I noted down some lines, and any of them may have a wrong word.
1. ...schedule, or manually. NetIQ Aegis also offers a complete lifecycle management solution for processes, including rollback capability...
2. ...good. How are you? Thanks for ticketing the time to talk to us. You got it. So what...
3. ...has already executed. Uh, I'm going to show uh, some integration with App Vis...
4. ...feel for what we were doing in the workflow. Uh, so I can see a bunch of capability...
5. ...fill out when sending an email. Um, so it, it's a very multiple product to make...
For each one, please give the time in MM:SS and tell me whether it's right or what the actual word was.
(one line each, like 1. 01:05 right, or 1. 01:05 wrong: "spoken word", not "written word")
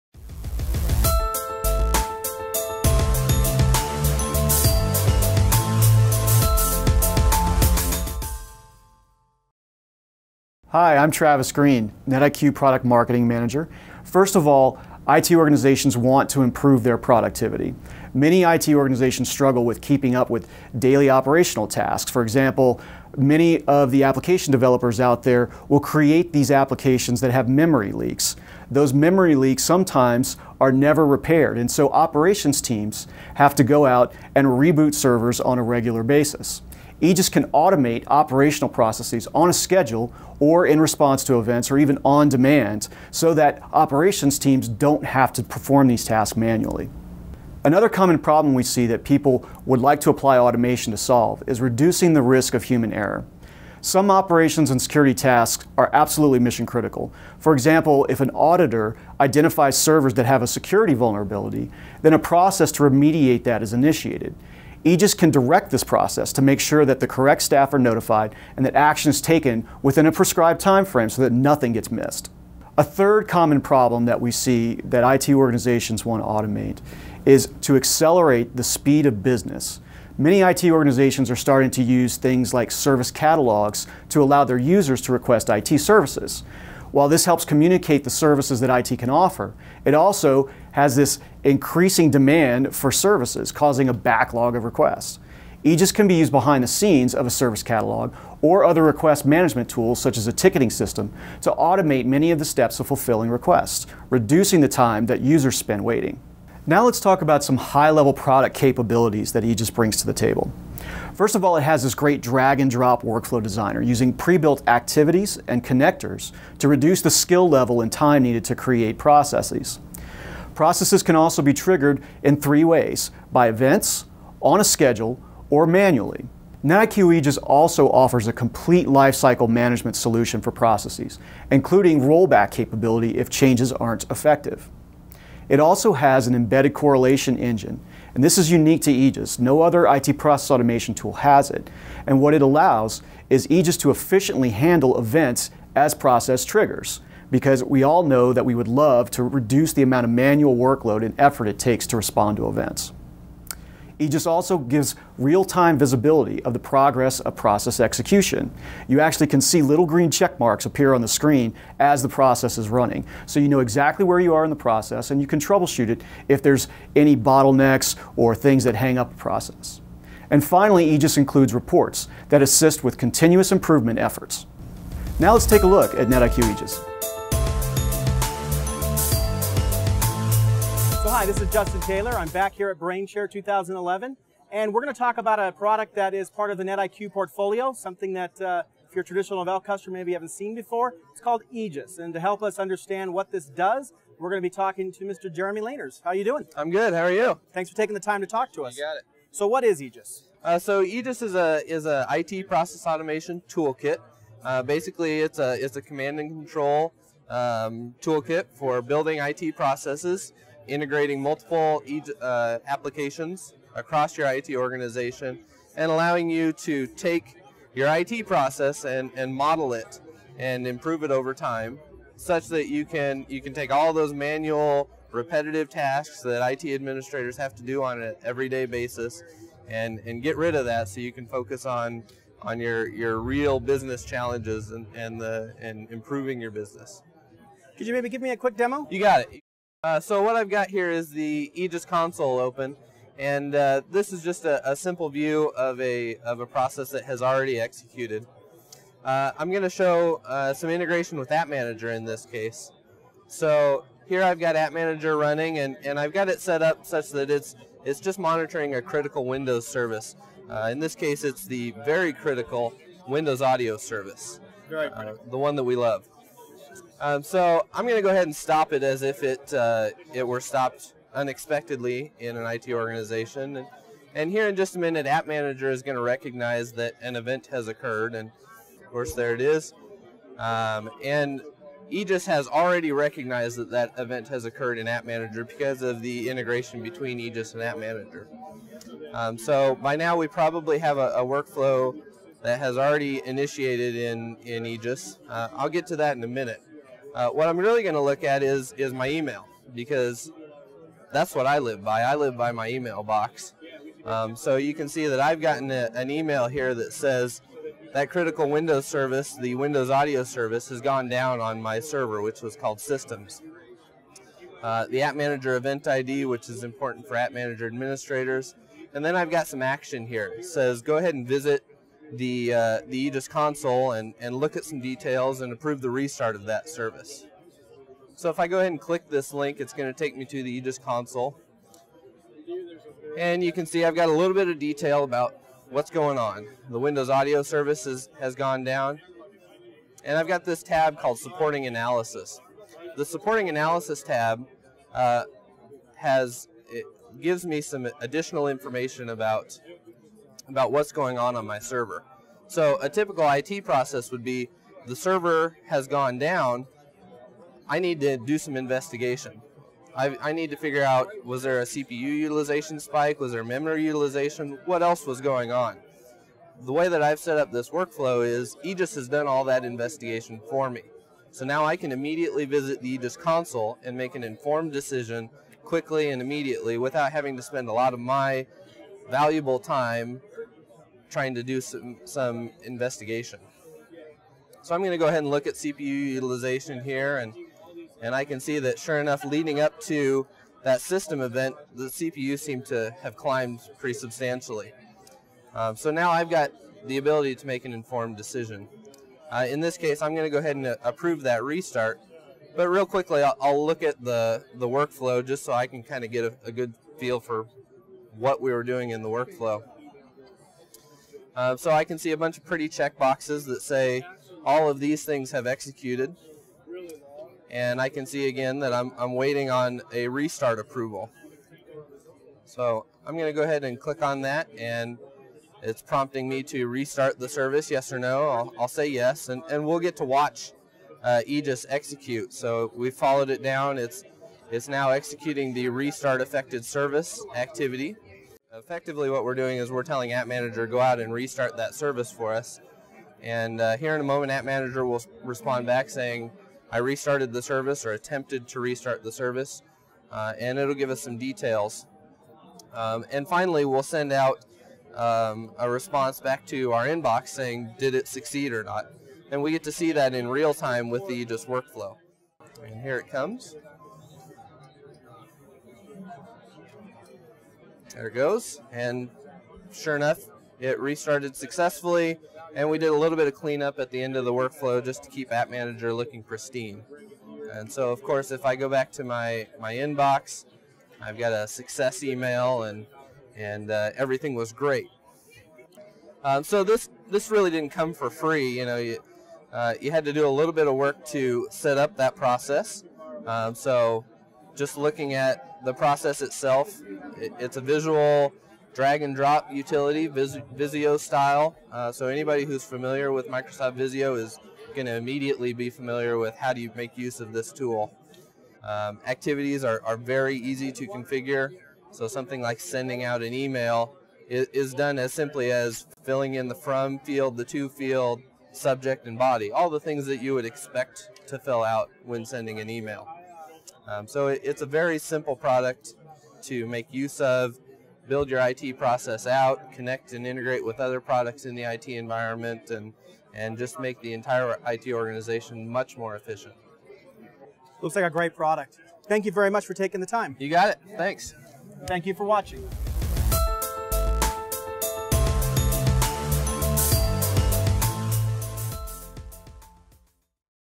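1. 02:04 right
2. 03:16 wrong: "taking", not "ticketing"
3. 04:07 wrong: "Manager", not "Vis"
4. 06:46 wrong: "pretty", not "capability"
5. 08:41 wrong: "simple", not "multiple".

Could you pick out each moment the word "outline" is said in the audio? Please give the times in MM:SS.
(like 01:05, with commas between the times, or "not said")
not said.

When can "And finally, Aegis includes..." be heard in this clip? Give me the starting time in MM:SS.
02:50.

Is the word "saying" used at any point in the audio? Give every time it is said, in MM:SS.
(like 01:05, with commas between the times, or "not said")
07:25, 07:37.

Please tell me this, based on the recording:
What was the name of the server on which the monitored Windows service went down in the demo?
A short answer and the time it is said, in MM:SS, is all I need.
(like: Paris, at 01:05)
Systems, at 05:12.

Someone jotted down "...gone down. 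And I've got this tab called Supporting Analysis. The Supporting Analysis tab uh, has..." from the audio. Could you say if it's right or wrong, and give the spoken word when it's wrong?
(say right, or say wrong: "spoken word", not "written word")
right.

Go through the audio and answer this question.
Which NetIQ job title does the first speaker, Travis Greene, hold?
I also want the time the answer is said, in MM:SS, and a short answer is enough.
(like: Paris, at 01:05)
Product Marketing Manager, at 00:12.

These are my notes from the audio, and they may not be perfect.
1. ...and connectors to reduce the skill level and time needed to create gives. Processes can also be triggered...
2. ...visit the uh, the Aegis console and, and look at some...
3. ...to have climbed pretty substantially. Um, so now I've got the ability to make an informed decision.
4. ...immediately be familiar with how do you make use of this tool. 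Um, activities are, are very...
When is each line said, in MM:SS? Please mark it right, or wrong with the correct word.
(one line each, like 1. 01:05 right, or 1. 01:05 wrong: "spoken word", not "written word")
1. 01:55 wrong: "processes", not "gives"
2. 05:21 right
3. 06:32 right
4. 08:24 right.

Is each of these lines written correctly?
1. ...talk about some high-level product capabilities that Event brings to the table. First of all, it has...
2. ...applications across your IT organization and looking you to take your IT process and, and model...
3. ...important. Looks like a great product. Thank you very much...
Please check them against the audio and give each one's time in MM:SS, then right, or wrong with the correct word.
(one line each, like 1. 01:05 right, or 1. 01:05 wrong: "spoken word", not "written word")
1. 01:46 wrong: "Aegis", not "Event"
2. 03:32 wrong: "allowing", not "looking"
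3. 08:56 wrong: "efficient", not "important".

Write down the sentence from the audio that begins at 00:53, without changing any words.
Some operations and security tasks are absolutely mission critical.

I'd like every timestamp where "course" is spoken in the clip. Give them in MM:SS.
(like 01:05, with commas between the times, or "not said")
04:38, 07:58.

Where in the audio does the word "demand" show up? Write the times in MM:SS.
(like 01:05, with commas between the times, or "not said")
00:42, 01:32.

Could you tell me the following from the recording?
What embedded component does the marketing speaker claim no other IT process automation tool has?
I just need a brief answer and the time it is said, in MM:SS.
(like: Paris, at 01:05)
Correlation engine, at 02:16.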